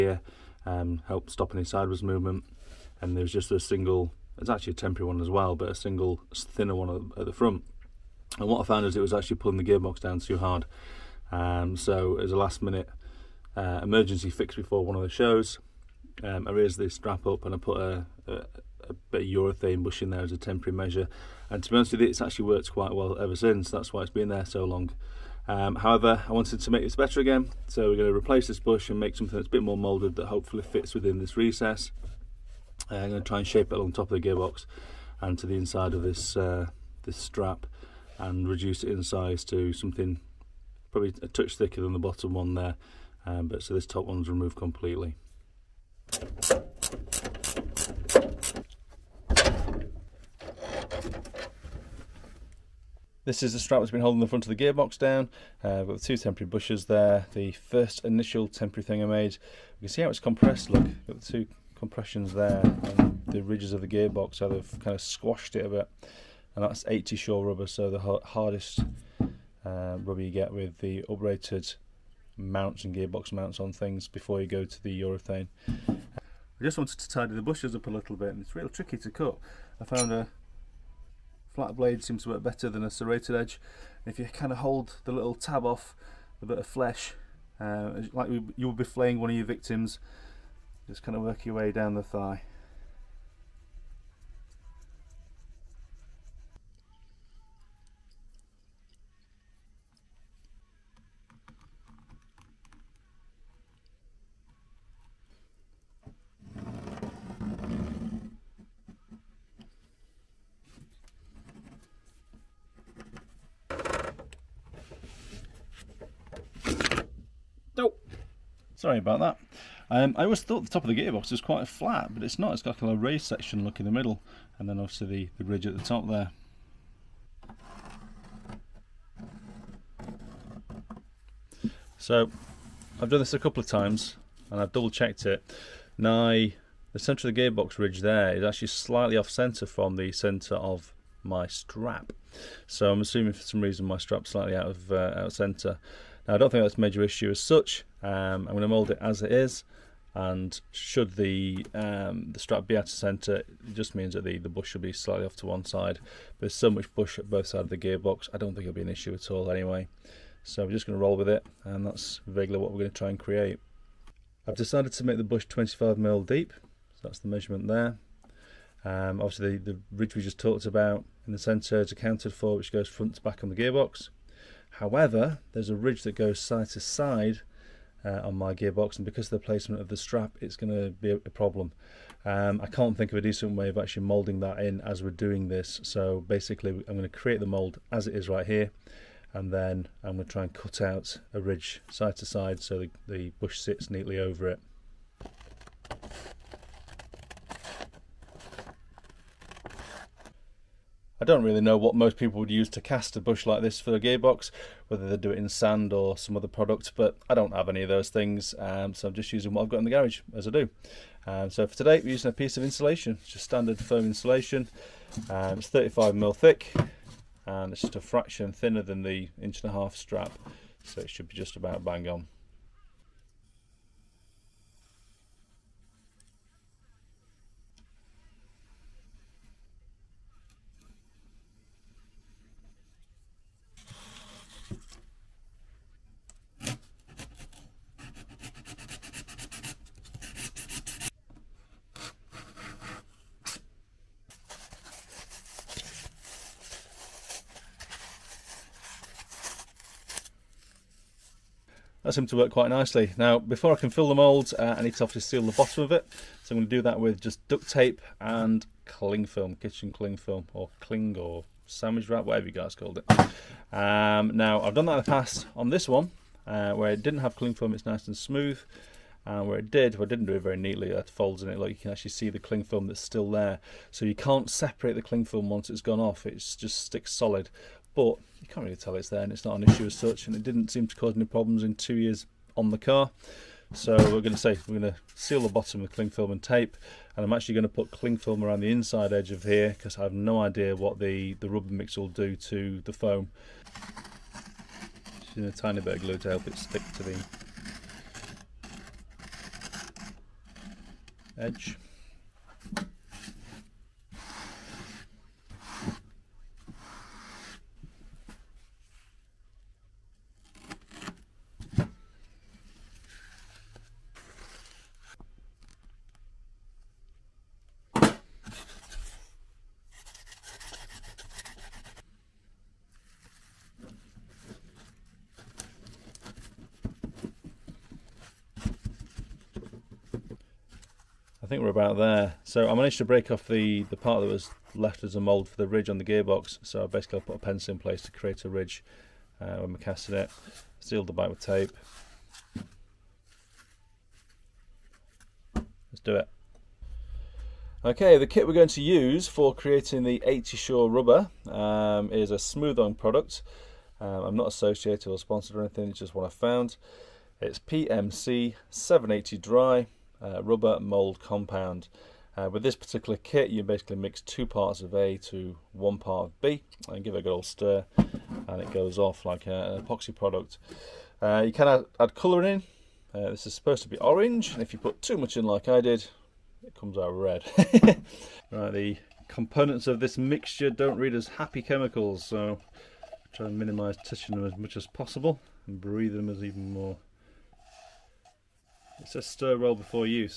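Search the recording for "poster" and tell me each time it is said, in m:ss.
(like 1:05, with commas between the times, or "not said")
not said.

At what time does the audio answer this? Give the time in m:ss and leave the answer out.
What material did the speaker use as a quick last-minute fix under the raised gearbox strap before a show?
0:19.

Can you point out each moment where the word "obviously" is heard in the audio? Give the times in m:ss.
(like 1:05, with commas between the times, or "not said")
2:04, 2:49, 4:15.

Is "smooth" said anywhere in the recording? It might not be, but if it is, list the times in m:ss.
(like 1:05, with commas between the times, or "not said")
4:28, 5:52.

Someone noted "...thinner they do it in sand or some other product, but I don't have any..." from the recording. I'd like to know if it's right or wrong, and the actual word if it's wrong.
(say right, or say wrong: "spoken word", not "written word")
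wrong: "whether", not "thinner".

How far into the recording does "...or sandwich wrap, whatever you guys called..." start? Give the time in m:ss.
4:21.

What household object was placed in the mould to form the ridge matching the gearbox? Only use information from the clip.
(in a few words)
a pencil.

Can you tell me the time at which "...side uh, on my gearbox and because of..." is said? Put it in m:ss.
2:56.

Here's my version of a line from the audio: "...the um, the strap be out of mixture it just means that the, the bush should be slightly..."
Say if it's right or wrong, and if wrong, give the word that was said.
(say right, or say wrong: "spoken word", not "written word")
wrong: "centre", not "mixture".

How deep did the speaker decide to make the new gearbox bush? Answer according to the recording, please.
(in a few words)
25mm.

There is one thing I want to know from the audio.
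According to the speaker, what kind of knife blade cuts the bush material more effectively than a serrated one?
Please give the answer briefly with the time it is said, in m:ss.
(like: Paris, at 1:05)
flat blade, at 1:21.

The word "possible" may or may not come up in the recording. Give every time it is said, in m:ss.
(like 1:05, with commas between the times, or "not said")
6:24.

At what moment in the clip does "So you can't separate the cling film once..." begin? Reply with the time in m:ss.
4:33.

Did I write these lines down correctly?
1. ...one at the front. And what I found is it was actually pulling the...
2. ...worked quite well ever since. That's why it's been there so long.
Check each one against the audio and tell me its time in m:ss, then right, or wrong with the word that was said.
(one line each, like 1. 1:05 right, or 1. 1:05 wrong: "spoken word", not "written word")
1. 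0:06 right
2. 0:22 right.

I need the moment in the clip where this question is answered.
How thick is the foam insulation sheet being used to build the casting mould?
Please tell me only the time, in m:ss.
3:35.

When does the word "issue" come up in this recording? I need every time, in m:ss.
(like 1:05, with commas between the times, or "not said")
2:27, 2:38, 4:39.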